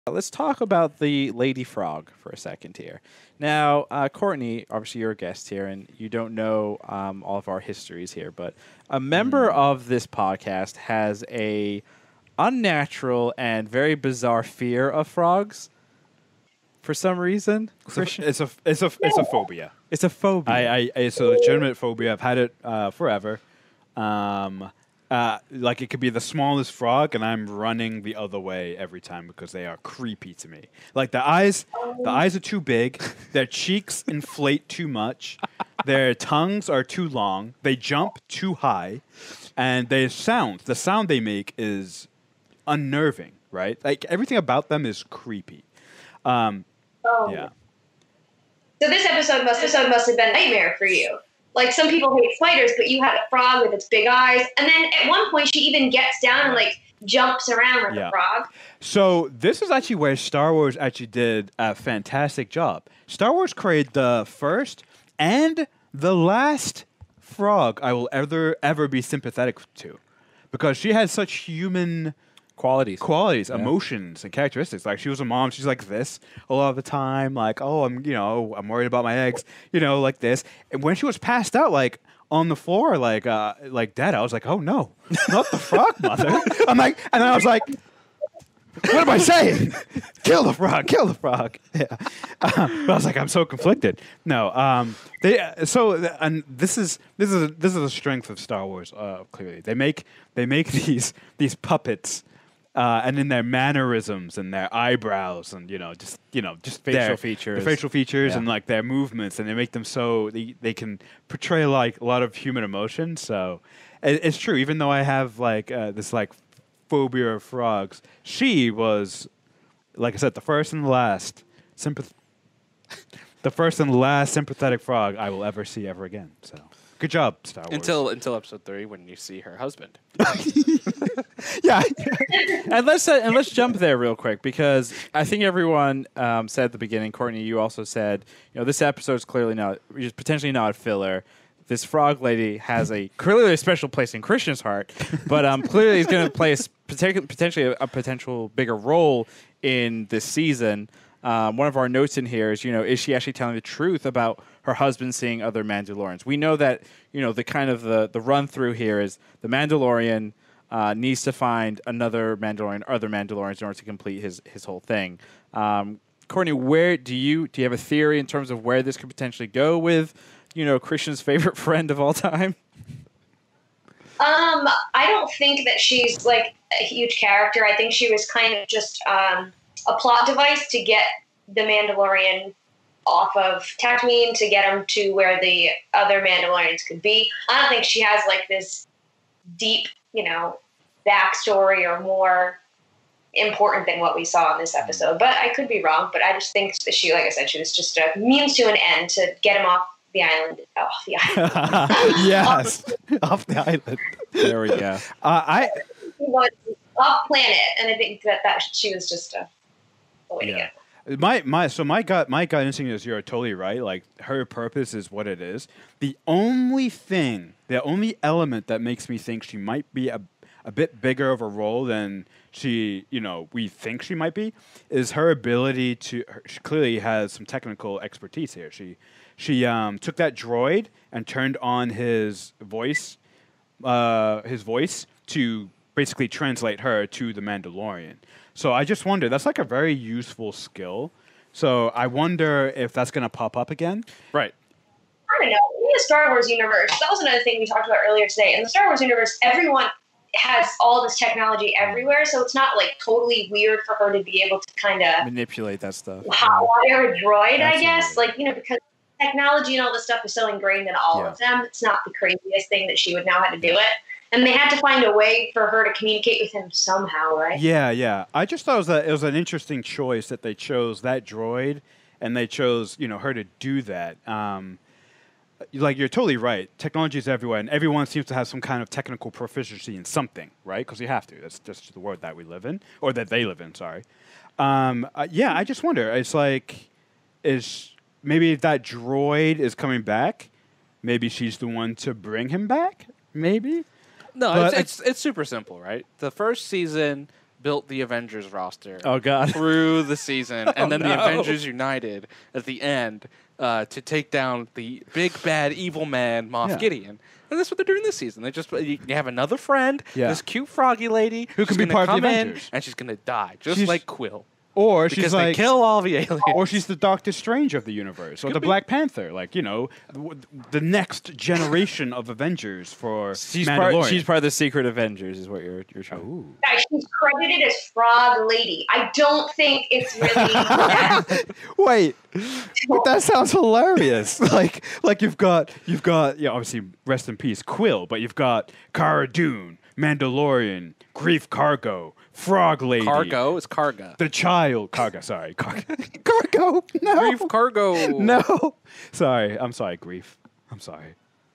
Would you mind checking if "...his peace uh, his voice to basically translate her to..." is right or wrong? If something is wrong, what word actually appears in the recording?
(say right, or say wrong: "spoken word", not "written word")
wrong: "voice", not "peace".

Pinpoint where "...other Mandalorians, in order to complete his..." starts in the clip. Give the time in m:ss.
2:42.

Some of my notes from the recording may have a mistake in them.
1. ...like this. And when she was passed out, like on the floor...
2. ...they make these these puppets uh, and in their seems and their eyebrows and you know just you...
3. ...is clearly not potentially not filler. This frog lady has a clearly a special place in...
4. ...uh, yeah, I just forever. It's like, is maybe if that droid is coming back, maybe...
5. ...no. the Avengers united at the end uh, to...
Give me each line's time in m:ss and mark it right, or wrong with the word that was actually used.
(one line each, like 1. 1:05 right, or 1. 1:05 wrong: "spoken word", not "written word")
1. 1:20 right
2. 1:40 wrong: "mannerisms", not "seems"
3. 2:19 right
4. 4:45 wrong: "wonder", not "forever"
5. 5:01 right.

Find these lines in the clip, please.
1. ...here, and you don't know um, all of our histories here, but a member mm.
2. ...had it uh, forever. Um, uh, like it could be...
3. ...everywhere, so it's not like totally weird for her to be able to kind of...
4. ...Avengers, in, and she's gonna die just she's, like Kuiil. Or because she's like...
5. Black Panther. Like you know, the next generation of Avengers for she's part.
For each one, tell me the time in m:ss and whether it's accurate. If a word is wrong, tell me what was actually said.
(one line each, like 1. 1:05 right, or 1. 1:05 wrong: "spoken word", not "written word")
1. 0:05 right
2. 0:22 right
3. 4:11 right
4. 5:12 right
5. 5:18 right.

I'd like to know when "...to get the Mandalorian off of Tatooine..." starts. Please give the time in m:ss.
3:00.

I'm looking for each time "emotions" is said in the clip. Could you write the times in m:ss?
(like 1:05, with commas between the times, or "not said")
1:13, 1:52.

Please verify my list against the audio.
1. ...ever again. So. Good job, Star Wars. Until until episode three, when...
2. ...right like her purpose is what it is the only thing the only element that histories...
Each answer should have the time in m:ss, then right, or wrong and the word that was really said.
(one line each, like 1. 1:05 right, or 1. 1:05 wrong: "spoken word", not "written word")
1. 2:05 right
2. 3:33 wrong: "makes", not "histories".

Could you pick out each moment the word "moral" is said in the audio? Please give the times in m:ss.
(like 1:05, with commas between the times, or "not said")
not said.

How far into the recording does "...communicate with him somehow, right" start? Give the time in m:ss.
4:25.